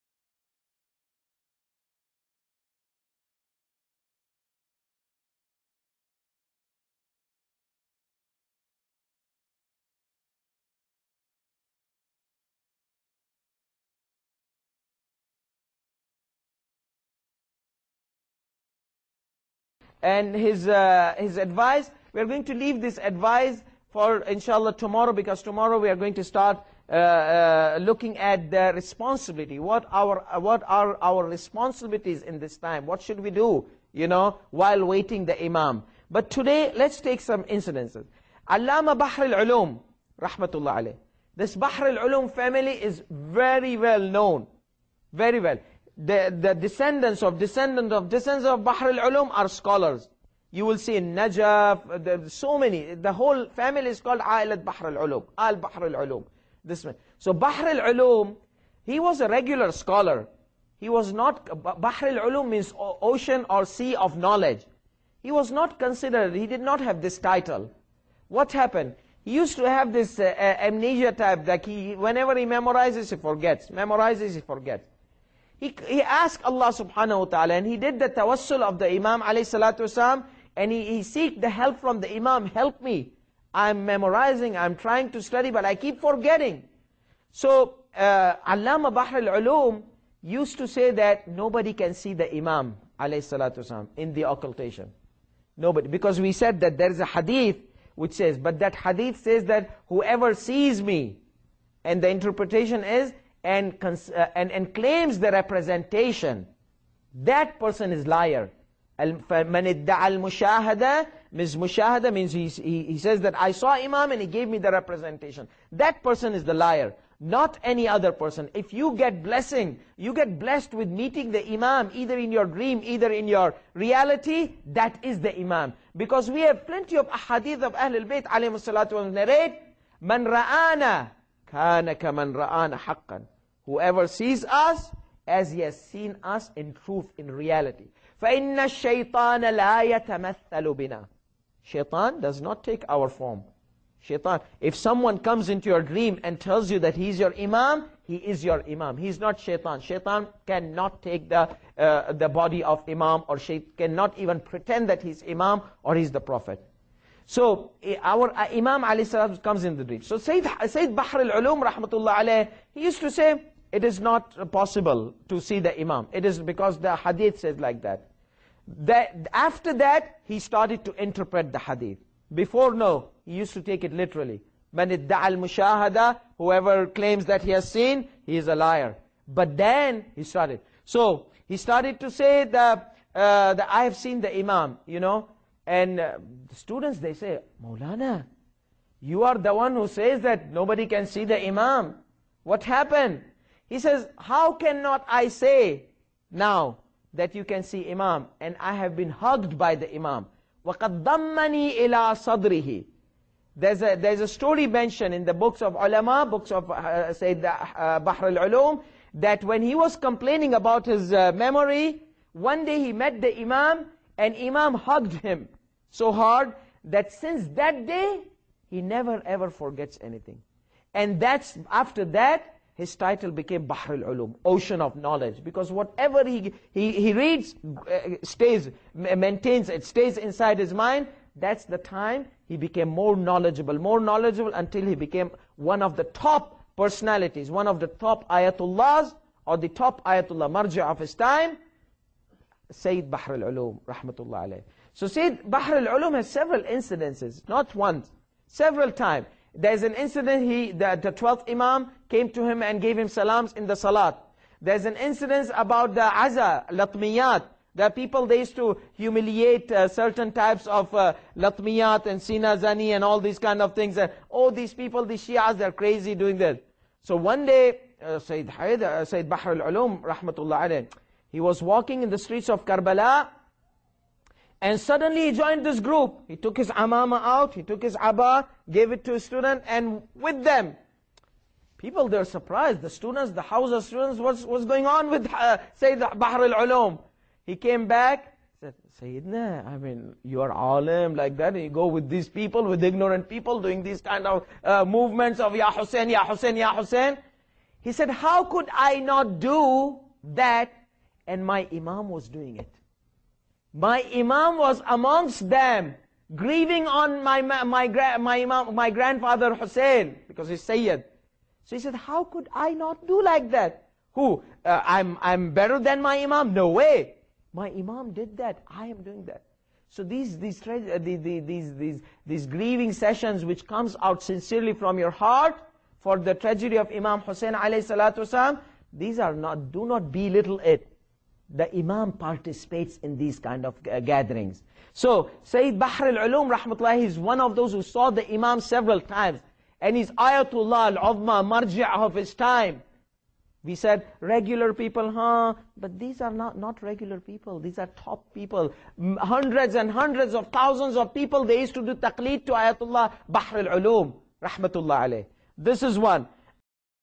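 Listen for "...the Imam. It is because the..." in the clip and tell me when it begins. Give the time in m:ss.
2:45.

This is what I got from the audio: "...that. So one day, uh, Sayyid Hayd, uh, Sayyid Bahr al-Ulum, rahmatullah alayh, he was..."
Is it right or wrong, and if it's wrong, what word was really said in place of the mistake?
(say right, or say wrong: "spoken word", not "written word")
right.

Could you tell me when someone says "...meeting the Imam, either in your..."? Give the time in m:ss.
2:00.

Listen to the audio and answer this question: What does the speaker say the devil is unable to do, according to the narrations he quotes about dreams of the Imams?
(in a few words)
Take our form.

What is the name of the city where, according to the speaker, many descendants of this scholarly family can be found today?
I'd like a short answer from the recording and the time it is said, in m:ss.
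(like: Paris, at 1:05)
Najaf, at 0:51.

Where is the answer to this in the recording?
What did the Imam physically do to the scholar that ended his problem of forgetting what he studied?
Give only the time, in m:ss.
3:34.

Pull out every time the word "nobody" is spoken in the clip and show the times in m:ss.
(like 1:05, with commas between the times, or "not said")
1:31, 1:35, 3:10.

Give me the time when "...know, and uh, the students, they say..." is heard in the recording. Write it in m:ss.
3:04.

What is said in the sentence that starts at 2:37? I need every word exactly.
So eh, our uh, Imam Ali Salam comes in the breach.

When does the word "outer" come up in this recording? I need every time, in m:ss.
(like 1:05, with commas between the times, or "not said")
not said.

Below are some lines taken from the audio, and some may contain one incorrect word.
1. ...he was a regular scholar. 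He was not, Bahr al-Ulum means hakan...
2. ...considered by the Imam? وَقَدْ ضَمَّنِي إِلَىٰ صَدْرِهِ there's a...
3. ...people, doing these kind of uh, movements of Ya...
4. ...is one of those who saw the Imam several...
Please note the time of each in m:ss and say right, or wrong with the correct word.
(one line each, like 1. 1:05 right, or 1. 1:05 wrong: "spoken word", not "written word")
1. 0:58 wrong: "ocean", not "hakan"
2. 3:19 wrong: "hugged", not "considered"
3. 4:53 right
4. 5:37 right.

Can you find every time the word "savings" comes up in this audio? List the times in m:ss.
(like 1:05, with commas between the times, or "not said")
not said.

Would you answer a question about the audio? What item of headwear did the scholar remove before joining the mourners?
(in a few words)
His amama.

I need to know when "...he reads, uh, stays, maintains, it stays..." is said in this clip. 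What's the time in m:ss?
3:46.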